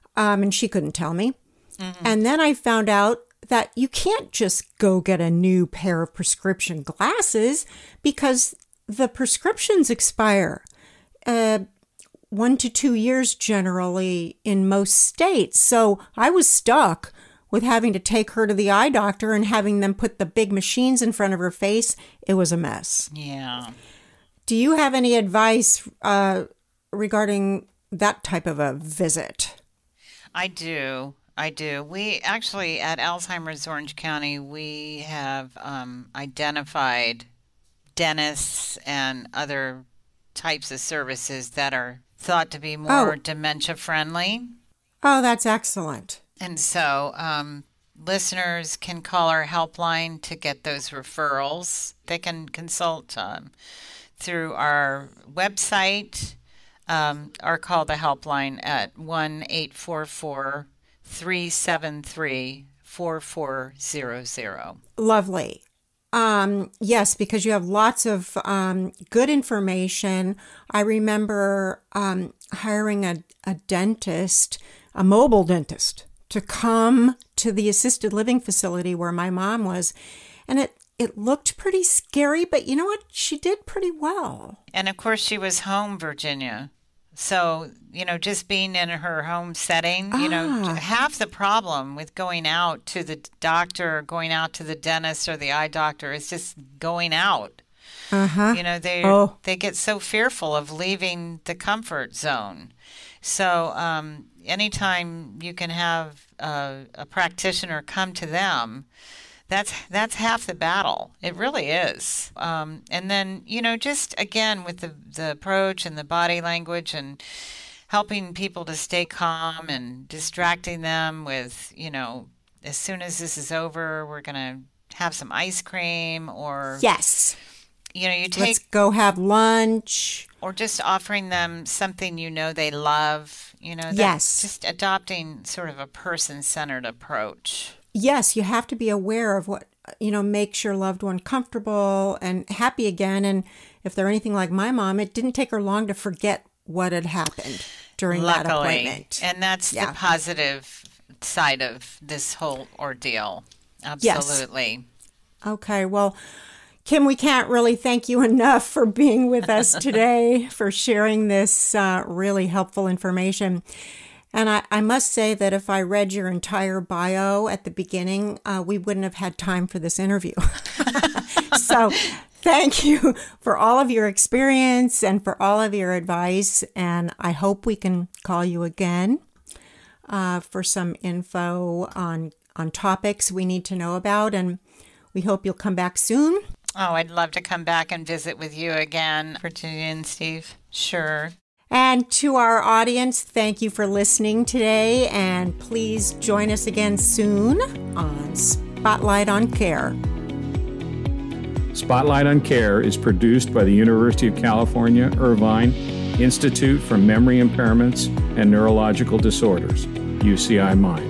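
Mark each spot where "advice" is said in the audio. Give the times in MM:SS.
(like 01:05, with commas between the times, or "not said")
00:25, 02:55.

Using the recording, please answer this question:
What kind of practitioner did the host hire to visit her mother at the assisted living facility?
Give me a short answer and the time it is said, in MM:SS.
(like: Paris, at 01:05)
A mobile dentist, at 01:15.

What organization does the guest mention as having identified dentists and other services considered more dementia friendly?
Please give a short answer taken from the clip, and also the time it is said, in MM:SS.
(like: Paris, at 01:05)
Alzheimer's Orange County, at 00:32.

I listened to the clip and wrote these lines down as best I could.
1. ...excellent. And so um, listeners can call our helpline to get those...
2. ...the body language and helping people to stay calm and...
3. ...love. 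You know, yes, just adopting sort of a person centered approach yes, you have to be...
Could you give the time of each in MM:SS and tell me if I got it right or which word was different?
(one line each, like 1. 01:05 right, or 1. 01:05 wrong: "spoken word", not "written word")
1. 00:45 right
2. 01:55 right
3. 02:12 right.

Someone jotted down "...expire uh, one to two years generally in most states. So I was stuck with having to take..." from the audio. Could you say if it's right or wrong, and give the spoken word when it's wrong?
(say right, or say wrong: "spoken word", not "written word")
right.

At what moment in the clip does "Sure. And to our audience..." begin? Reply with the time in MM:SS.
03:10.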